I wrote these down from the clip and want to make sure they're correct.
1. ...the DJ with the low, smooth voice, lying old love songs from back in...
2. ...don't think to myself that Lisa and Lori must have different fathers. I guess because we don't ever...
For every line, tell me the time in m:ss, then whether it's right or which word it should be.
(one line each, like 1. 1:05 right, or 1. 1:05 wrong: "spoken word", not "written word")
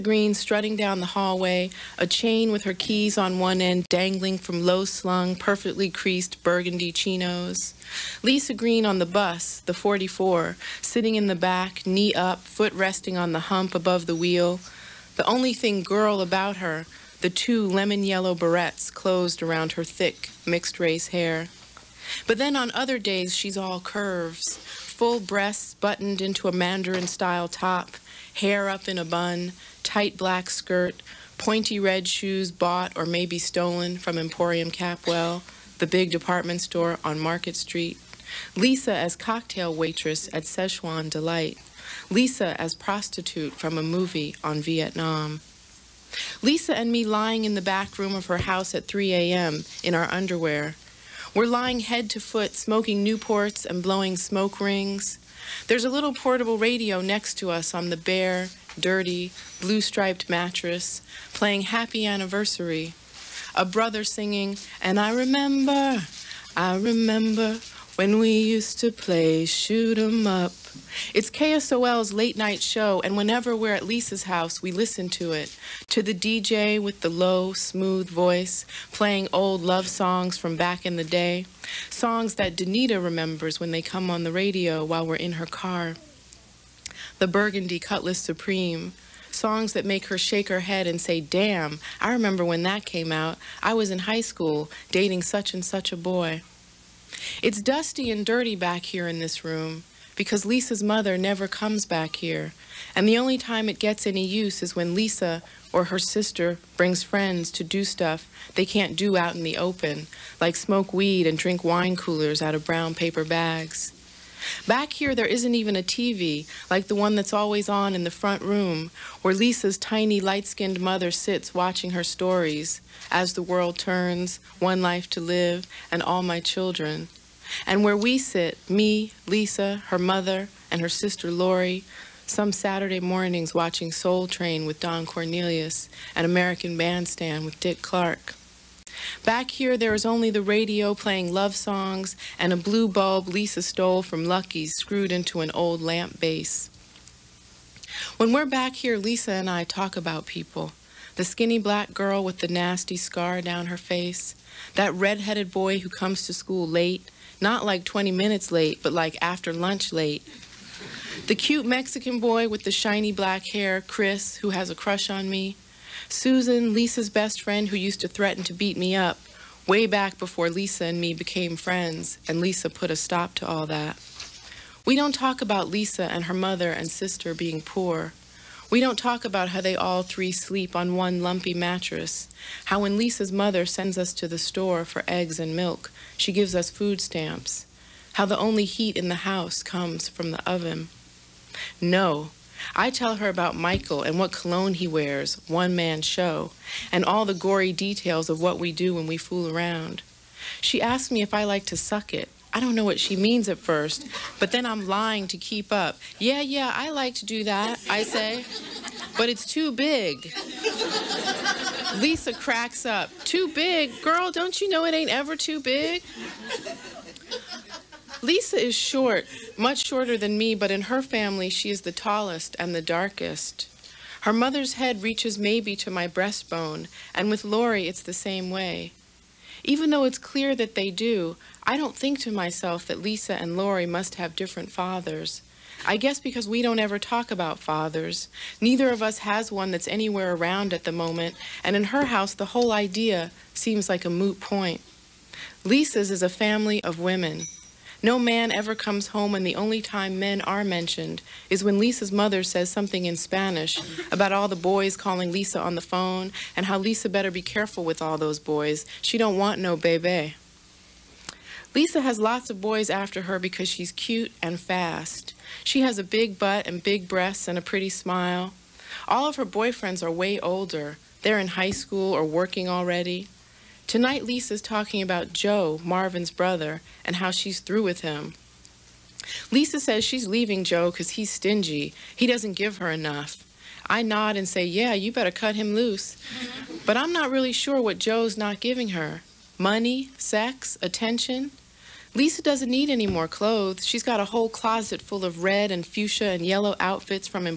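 1. 1:16 wrong: "playing", not "lying"
2. 3:51 right.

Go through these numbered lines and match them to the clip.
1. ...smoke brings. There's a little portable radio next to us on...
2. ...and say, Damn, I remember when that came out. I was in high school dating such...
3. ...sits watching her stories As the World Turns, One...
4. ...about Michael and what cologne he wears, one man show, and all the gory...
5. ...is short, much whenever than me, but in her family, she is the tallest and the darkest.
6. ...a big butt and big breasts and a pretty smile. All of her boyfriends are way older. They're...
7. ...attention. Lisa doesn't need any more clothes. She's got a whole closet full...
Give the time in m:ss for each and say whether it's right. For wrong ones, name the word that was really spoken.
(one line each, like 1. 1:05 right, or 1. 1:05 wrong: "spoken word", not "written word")
1. 0:54 wrong: "rings", not "brings"
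2. 1:30 right
3. 2:01 right
4. 3:13 right
5. 3:38 wrong: "shorter", not "whenever"
6. 4:25 right
7. 4:50 right.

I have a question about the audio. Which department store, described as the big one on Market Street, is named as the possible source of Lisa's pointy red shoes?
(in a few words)
Emporium Capwell.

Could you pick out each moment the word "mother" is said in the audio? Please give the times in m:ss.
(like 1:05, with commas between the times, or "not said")
1:40, 2:00, 2:09, 2:56, 3:03, 3:44, 4:12.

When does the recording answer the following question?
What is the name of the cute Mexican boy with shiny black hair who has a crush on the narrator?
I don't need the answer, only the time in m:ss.
2:43.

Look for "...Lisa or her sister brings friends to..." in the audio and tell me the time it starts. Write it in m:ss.
1:44.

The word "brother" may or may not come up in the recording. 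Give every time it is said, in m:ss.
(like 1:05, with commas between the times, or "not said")
1:03, 4:36.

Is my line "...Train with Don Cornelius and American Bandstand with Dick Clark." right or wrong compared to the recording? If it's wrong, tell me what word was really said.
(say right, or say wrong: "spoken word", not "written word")
right.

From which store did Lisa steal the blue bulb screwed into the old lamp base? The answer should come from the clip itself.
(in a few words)
Lucky's.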